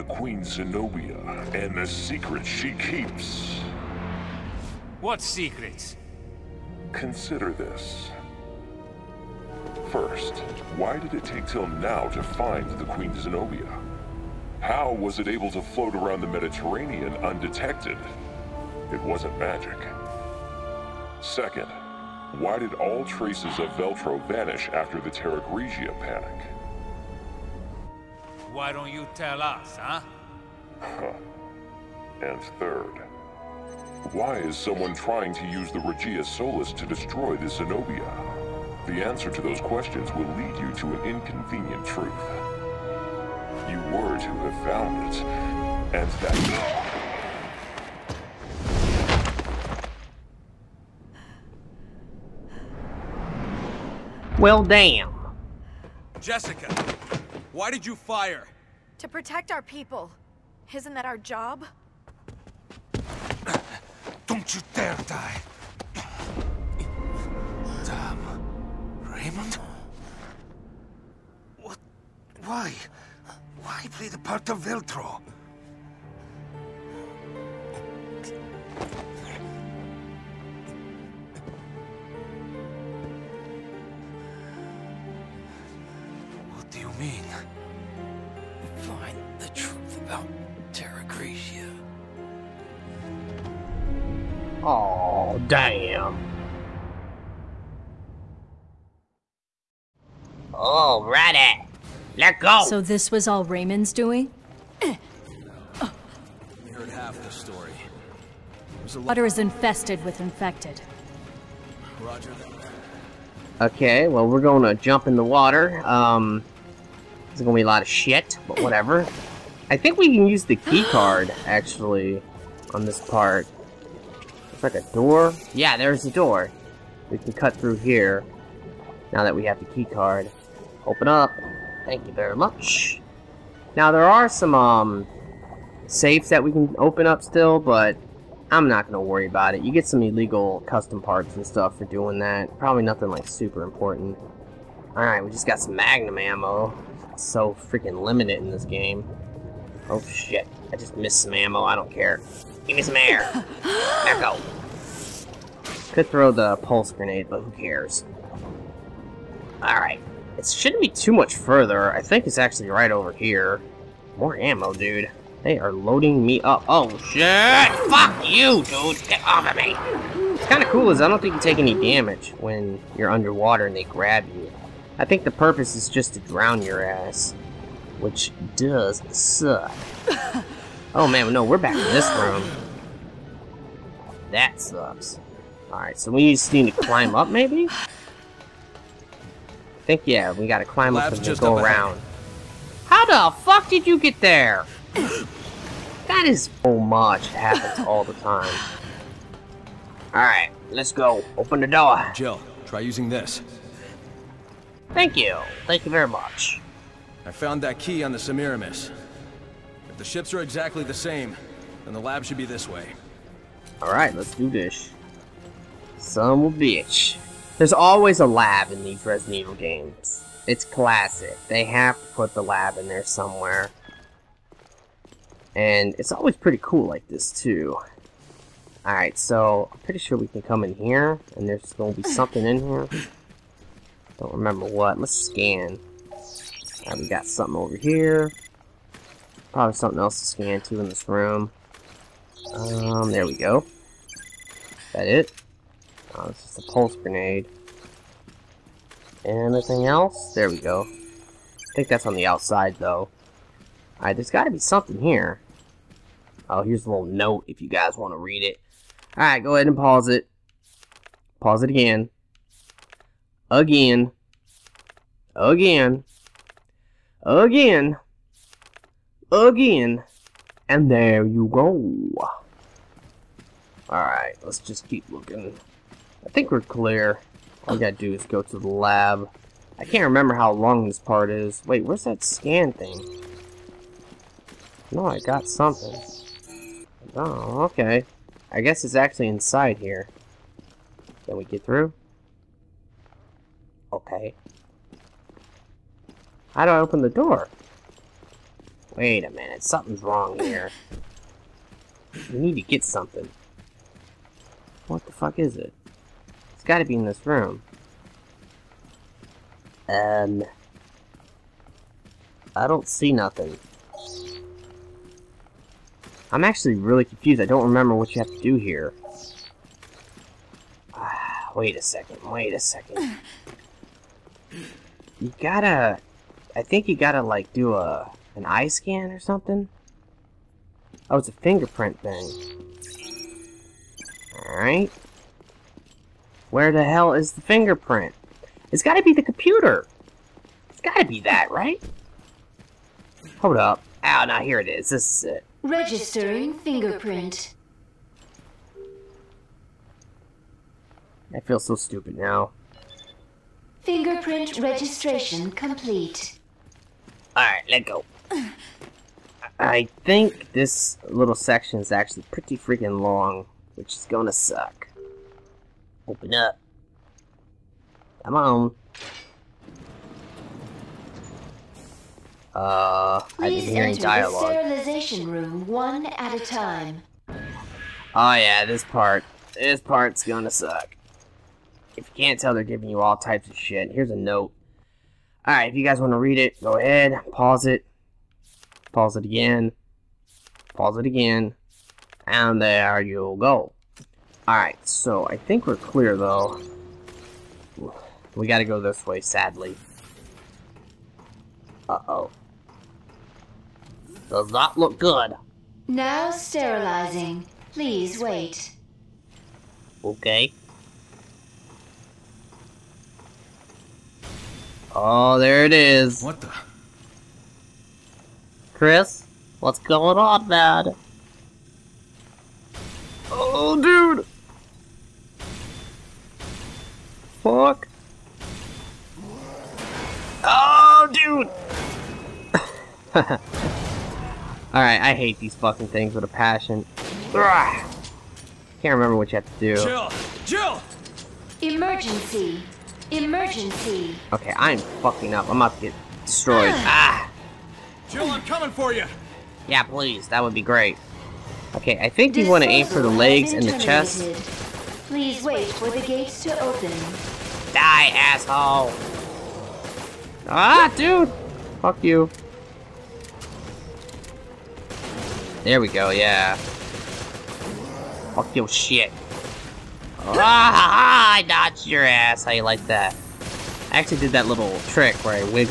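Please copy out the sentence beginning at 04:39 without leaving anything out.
I can't remember how long this part is.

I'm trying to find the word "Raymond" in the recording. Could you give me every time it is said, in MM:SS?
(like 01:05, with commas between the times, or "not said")
01:09, 01:43.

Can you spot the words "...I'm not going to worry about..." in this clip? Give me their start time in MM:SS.
02:18.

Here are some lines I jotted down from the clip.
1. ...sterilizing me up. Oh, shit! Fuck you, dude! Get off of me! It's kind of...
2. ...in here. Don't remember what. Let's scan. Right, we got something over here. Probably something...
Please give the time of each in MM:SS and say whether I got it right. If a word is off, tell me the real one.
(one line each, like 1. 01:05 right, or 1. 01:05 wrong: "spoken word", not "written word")
1. 02:45 wrong: "loading", not "sterilizing"
2. 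03:52 right.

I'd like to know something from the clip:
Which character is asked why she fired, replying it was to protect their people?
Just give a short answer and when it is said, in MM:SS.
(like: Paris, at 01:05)
Jessica, at 00:56.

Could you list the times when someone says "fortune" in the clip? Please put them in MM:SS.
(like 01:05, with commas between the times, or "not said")
not said.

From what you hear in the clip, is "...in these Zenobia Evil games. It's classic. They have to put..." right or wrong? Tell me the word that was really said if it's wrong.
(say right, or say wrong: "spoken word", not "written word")
wrong: "Resident", not "Zenobia".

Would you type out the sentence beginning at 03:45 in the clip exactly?
And it's always pretty cool like this, too.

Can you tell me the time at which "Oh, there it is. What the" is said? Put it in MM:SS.
06:54.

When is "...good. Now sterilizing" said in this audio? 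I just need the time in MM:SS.
06:44.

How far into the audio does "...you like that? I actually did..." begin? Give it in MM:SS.
07:52.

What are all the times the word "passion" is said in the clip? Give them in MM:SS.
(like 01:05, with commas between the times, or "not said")
07:16.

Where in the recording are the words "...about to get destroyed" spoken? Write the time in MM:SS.
07:25.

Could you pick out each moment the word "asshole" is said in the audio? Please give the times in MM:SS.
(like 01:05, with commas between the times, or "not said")
07:38.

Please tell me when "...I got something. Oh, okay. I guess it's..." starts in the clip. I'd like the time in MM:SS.
04:45.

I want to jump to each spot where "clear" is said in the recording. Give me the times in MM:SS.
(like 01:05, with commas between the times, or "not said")
04:36, 06:35.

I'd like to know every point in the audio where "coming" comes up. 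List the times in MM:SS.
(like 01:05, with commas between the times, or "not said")
07:28.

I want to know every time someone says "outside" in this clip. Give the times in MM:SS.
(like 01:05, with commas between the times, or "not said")
04:12.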